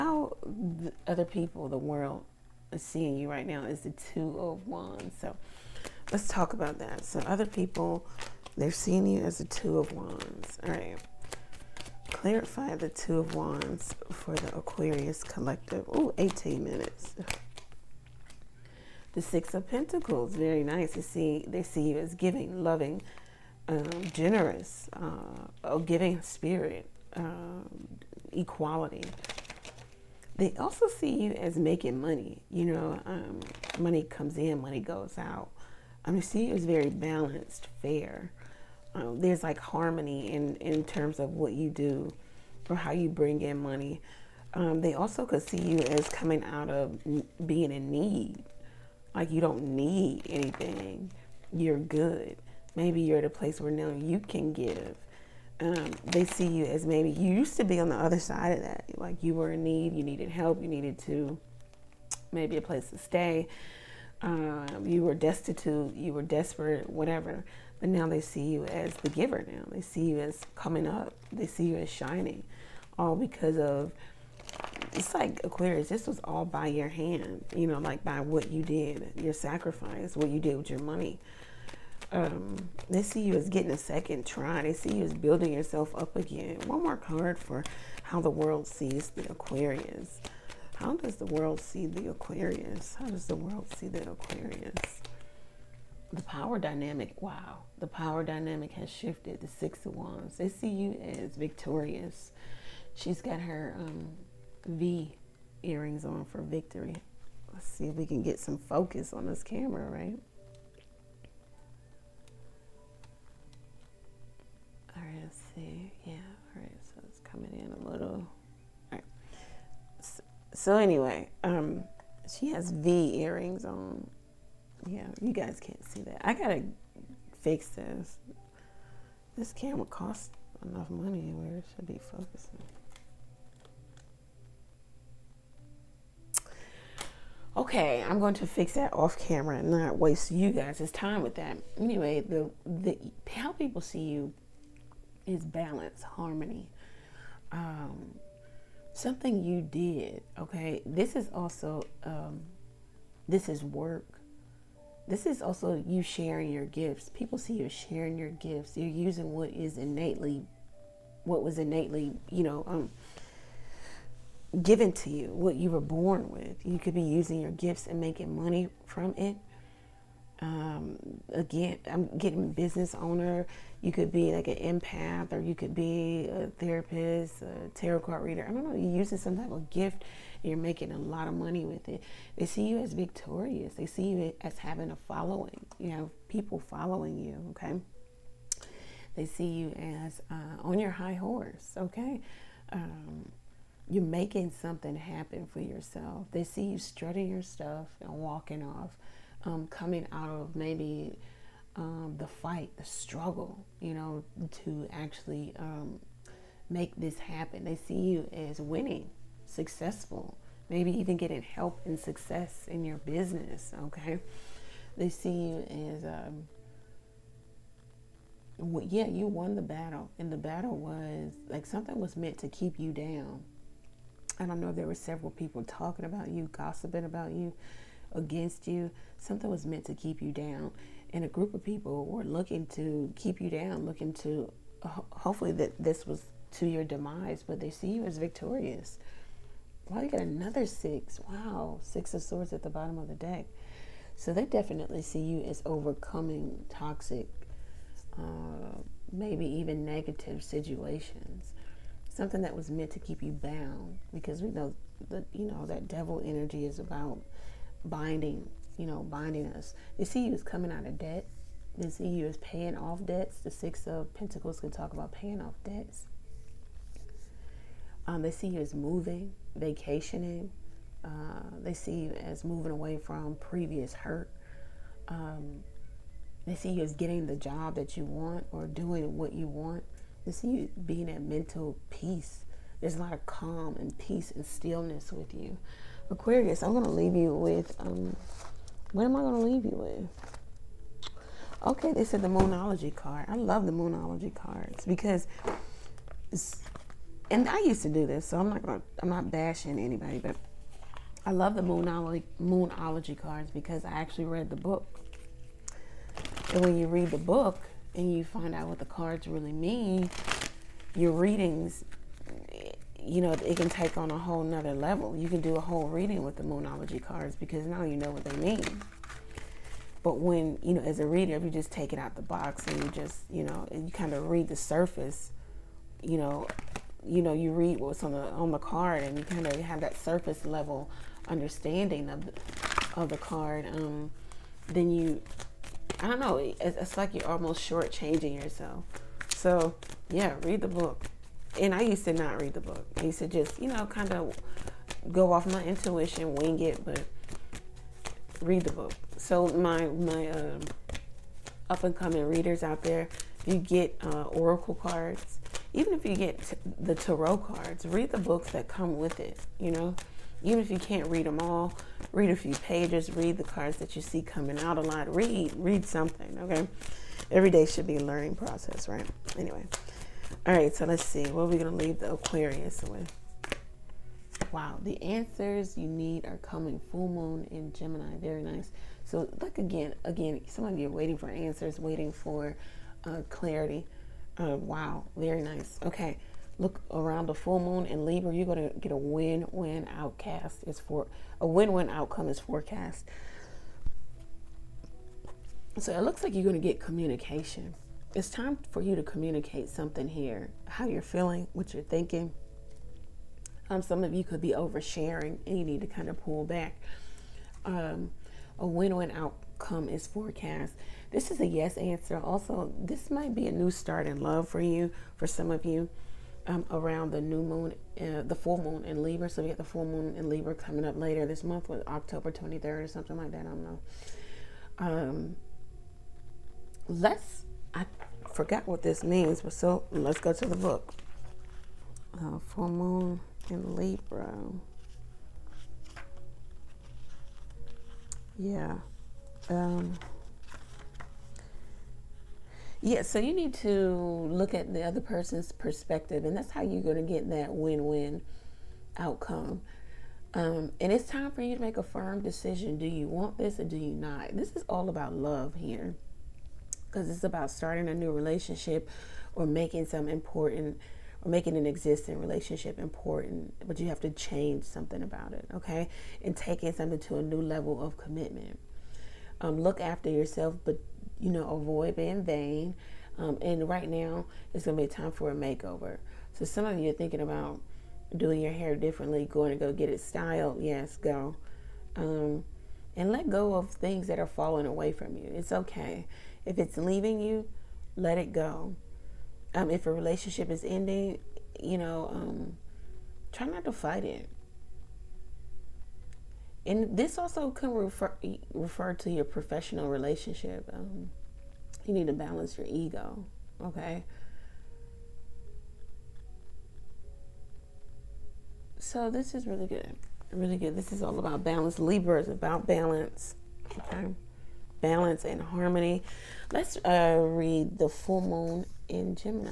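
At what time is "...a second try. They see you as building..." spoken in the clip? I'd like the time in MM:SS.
01:23.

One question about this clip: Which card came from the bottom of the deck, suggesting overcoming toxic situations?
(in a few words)
Six of Swords.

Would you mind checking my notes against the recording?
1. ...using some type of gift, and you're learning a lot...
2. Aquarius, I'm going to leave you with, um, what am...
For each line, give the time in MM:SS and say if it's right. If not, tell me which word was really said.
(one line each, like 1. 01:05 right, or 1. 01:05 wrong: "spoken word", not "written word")
1. 02:58 wrong: "making", not "learning"
2. 04:46 right.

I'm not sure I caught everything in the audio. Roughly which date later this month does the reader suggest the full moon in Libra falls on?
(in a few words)
October 23.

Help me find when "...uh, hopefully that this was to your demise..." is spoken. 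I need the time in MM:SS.
03:54.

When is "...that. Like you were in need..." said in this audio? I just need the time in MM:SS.
00:58.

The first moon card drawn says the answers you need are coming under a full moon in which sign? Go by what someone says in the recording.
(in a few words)
Gemini.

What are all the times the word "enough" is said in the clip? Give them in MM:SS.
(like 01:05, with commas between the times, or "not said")
02:10.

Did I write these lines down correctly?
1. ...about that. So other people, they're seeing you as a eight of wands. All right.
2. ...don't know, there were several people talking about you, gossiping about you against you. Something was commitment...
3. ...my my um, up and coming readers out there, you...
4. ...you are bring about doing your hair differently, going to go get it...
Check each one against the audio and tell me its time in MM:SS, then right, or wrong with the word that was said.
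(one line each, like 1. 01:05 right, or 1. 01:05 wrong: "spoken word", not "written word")
1. 00:06 wrong: "two", not "eight"
2. 03:44 wrong: "meant", not "commitment"
3. 05:49 right
4. 07:56 wrong: "thinking", not "bring".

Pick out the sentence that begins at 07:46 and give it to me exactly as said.
And taking something to a new level of commitment.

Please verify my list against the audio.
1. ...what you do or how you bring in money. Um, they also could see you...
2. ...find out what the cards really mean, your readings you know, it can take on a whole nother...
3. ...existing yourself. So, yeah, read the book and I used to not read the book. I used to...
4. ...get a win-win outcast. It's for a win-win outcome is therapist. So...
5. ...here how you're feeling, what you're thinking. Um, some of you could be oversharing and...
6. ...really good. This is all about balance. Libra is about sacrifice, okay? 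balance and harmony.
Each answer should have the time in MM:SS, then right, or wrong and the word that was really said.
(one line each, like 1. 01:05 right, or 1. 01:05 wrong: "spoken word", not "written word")
1. 00:41 right
2. 05:08 right
3. 05:37 wrong: "shortchanging", not "existing"
4. 06:28 wrong: "forecast", not "therapist"
5. 06:40 right
6. 08:30 wrong: "balance", not "sacrifice".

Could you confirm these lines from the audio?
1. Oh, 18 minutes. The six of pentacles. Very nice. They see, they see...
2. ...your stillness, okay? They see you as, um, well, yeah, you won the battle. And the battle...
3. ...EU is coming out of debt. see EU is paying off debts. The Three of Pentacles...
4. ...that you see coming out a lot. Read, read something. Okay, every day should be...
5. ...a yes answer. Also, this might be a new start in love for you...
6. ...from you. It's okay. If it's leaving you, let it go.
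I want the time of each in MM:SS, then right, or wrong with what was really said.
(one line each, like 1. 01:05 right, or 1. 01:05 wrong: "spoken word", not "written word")
1. 00:15 right
2. 03:32 wrong: "business", not "stillness"
3. 04:20 wrong: "Six", not "Three"
4. 06:03 right
5. 06:51 right
6. 08:04 right.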